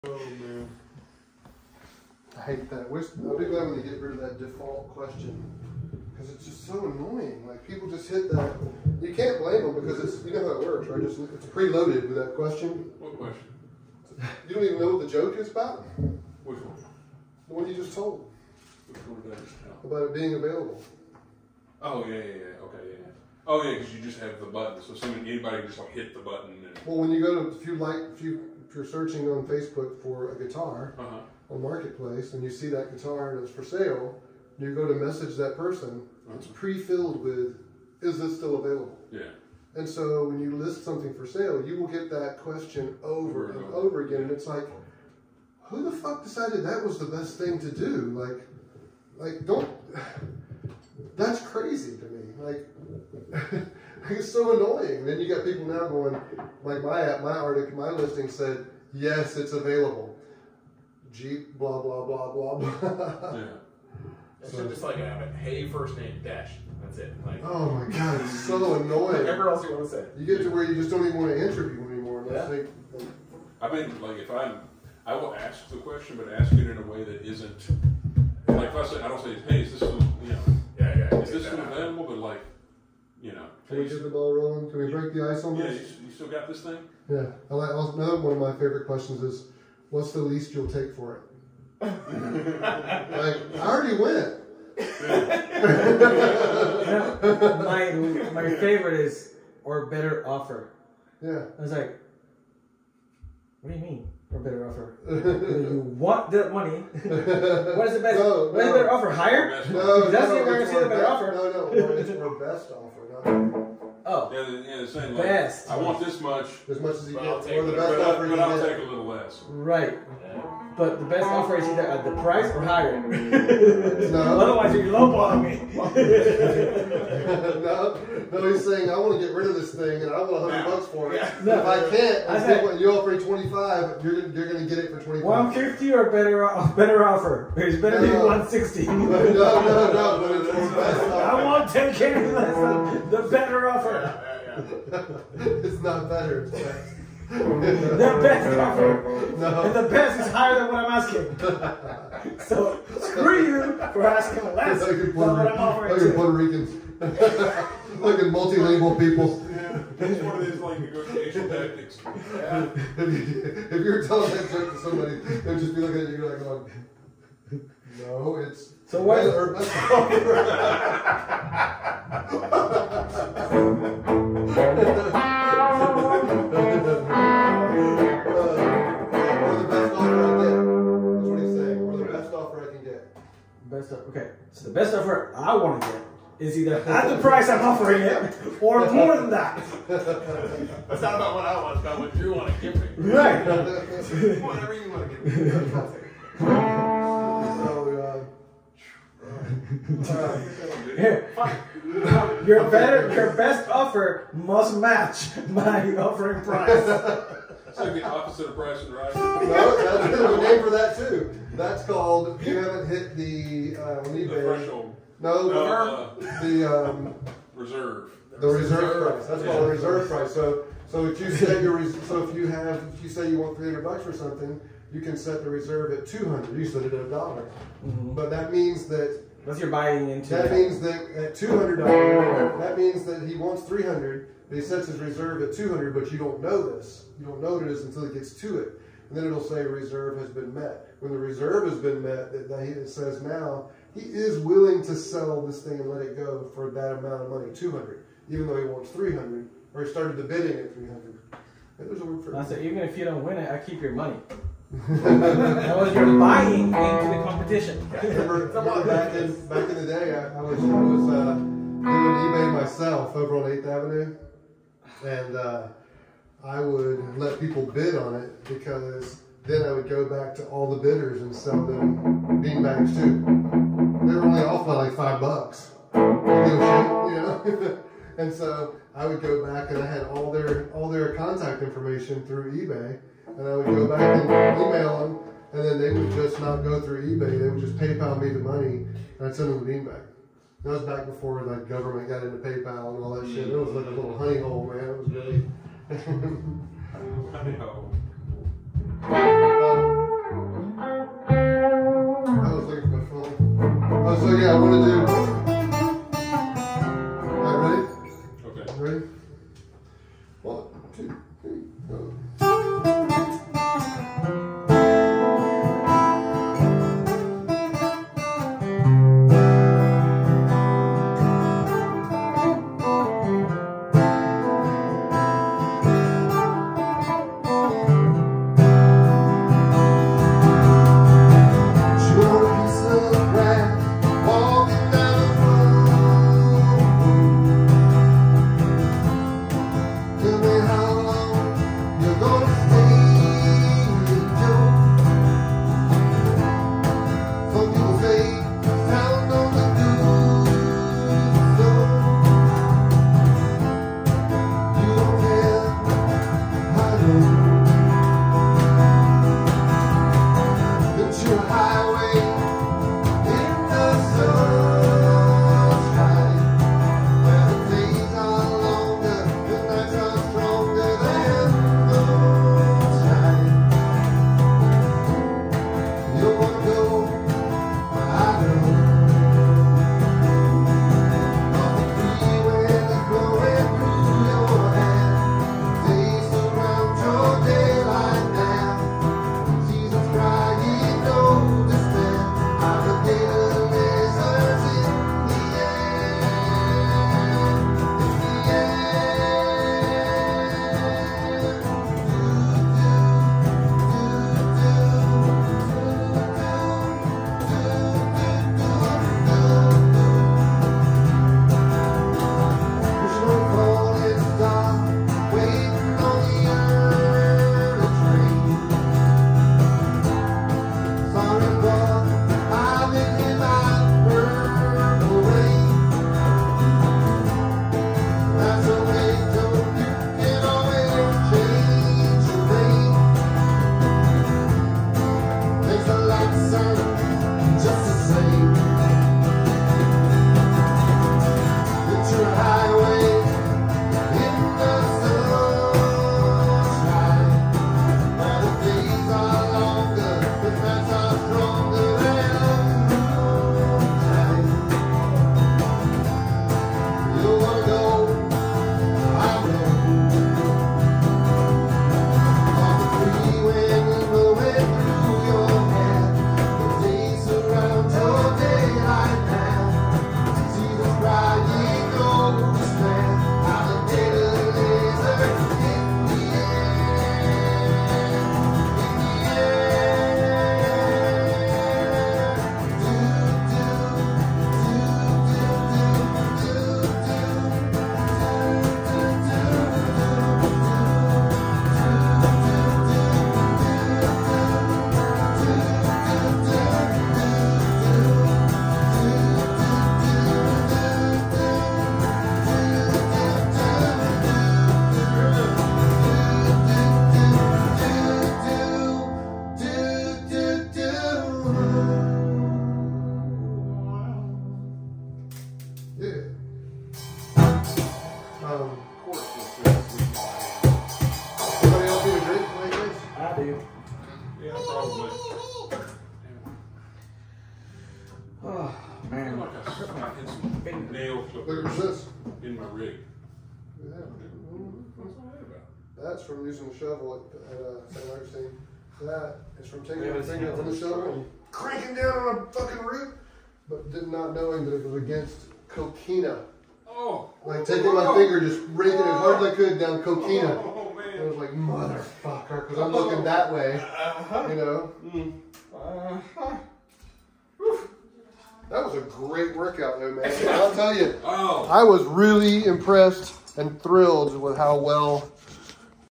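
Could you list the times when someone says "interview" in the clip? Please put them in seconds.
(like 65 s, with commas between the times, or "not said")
71 s.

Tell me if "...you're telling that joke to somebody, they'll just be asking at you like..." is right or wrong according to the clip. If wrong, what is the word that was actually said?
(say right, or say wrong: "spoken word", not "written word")
wrong: "looking", not "asking".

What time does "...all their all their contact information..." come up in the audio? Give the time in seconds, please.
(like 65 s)
280 s.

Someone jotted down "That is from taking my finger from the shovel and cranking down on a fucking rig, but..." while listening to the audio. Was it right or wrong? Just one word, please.
right.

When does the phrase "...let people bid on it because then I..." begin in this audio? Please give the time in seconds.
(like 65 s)
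267 s.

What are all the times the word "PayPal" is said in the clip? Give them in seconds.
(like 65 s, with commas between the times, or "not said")
287 s, 292 s.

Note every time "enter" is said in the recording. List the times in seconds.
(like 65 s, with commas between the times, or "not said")
not said.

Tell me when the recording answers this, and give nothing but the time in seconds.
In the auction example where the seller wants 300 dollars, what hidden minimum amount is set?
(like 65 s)
226 s.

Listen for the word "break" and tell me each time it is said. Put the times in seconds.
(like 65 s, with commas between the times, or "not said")
84 s.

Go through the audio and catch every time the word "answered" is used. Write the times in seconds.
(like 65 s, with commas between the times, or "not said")
not said.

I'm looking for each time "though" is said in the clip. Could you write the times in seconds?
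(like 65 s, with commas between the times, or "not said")
248 s, 559 s.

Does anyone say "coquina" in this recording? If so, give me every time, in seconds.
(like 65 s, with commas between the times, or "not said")
545 s, 550 s.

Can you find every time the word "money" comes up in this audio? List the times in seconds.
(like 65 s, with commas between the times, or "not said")
106 s, 247 s, 253 s, 288 s.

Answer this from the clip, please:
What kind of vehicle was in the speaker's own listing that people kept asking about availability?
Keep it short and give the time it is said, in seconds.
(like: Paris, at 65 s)
Jeep, at 61 s.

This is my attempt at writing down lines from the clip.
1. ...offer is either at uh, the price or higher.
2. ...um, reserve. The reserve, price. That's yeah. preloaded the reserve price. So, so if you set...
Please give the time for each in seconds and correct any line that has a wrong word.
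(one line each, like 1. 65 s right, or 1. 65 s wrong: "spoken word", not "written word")
1. 121 s right
2. 216 s wrong: "called", not "preloaded".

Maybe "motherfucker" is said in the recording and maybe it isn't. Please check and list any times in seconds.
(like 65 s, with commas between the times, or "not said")
551 s.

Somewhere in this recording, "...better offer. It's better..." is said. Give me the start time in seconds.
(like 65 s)
136 s.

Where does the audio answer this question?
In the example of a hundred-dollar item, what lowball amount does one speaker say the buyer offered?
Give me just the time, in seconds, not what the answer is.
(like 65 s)
133 s.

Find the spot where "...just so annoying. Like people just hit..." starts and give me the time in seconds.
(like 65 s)
6 s.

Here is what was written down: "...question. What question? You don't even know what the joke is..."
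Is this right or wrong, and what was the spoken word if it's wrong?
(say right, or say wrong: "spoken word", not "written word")
right.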